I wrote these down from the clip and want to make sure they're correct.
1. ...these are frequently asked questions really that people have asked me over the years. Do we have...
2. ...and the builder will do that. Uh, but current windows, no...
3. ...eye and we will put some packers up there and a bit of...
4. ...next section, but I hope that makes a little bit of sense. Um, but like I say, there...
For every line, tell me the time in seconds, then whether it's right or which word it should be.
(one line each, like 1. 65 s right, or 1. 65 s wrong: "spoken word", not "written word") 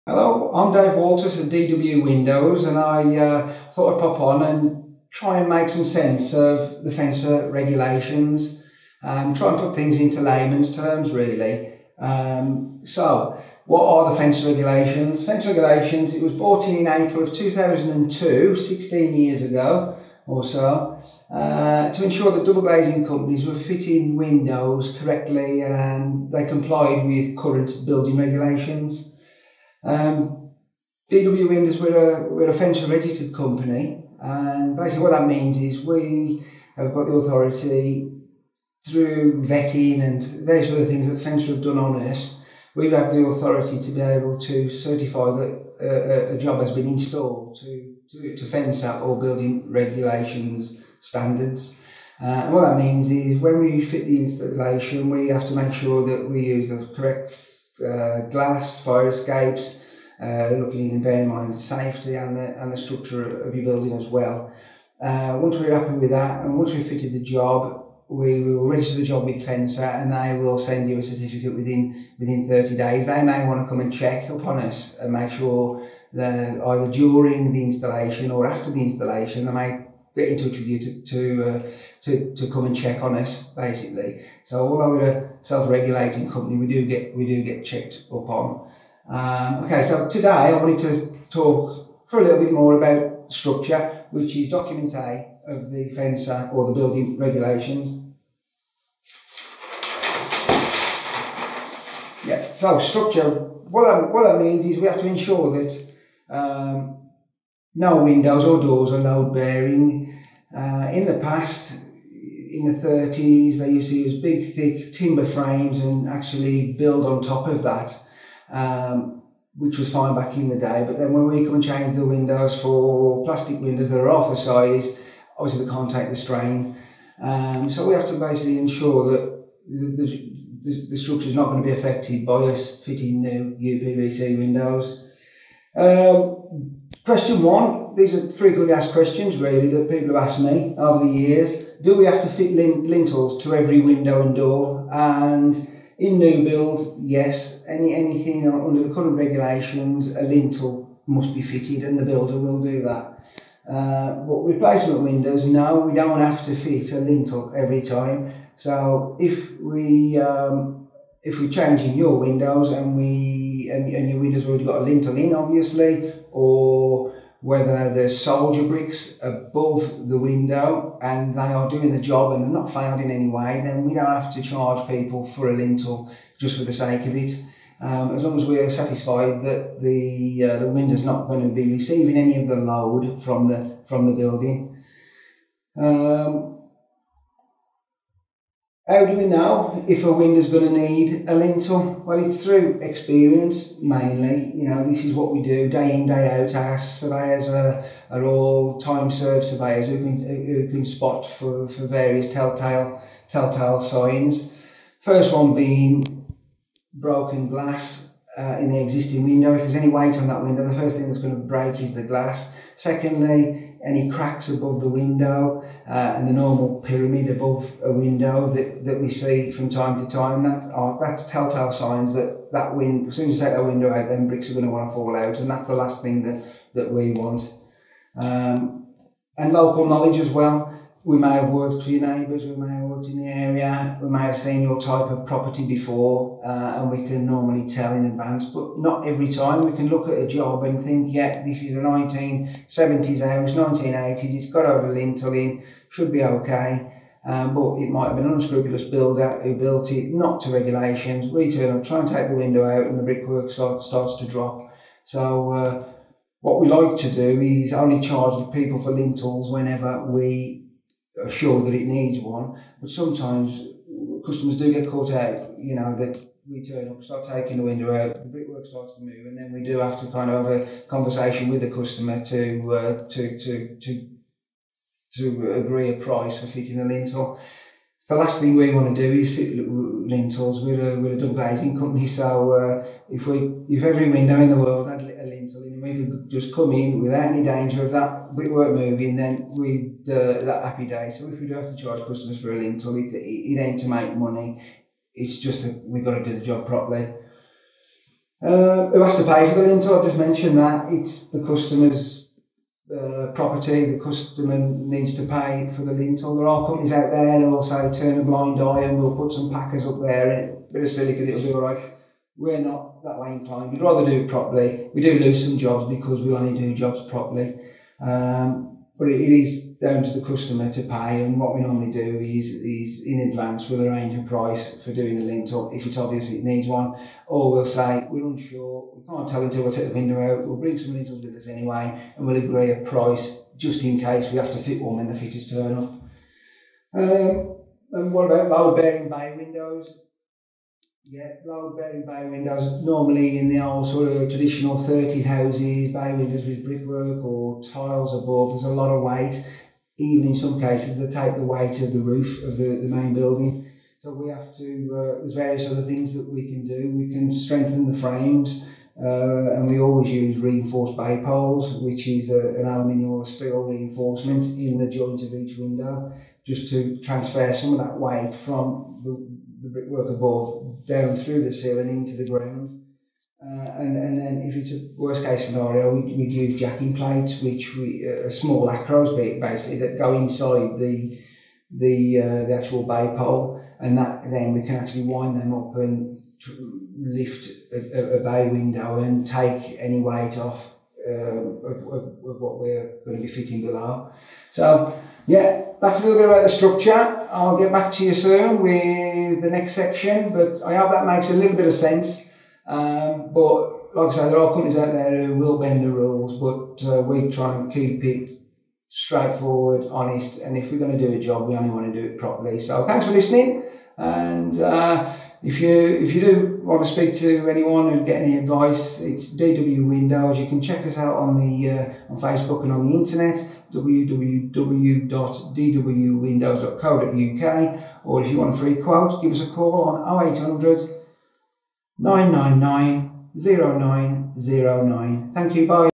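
1. 137 s right
2. 151 s wrong: "replacement", not "current"
3. 308 s right
4. 399 s right.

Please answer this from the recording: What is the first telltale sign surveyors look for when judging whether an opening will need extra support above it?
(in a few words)
Broken glass.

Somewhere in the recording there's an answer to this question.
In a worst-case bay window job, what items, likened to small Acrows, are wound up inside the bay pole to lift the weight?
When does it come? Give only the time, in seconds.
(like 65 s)
376 s.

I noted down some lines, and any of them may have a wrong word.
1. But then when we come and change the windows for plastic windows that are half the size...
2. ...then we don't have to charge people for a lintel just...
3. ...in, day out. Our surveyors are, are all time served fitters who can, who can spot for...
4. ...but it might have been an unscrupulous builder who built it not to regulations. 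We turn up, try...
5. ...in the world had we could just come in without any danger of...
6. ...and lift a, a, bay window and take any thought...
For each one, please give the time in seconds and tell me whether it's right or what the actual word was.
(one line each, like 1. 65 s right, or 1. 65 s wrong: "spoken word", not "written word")
1. 120 s right
2. 173 s right
3. 195 s wrong: "surveyors", not "fitters"
4. 247 s right
5. 284 s right
6. 385 s wrong: "weight", not "thought".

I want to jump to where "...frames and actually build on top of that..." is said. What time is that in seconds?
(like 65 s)
115 s.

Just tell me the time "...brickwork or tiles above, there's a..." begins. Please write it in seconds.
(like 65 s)
346 s.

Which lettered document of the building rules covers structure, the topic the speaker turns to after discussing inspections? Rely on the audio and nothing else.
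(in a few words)
Document A.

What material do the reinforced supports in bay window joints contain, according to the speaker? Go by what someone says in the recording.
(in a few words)
Aluminium or steel.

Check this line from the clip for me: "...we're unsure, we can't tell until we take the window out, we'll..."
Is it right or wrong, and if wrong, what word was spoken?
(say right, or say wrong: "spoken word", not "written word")
right.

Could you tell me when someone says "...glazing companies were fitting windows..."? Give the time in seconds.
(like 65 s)
22 s.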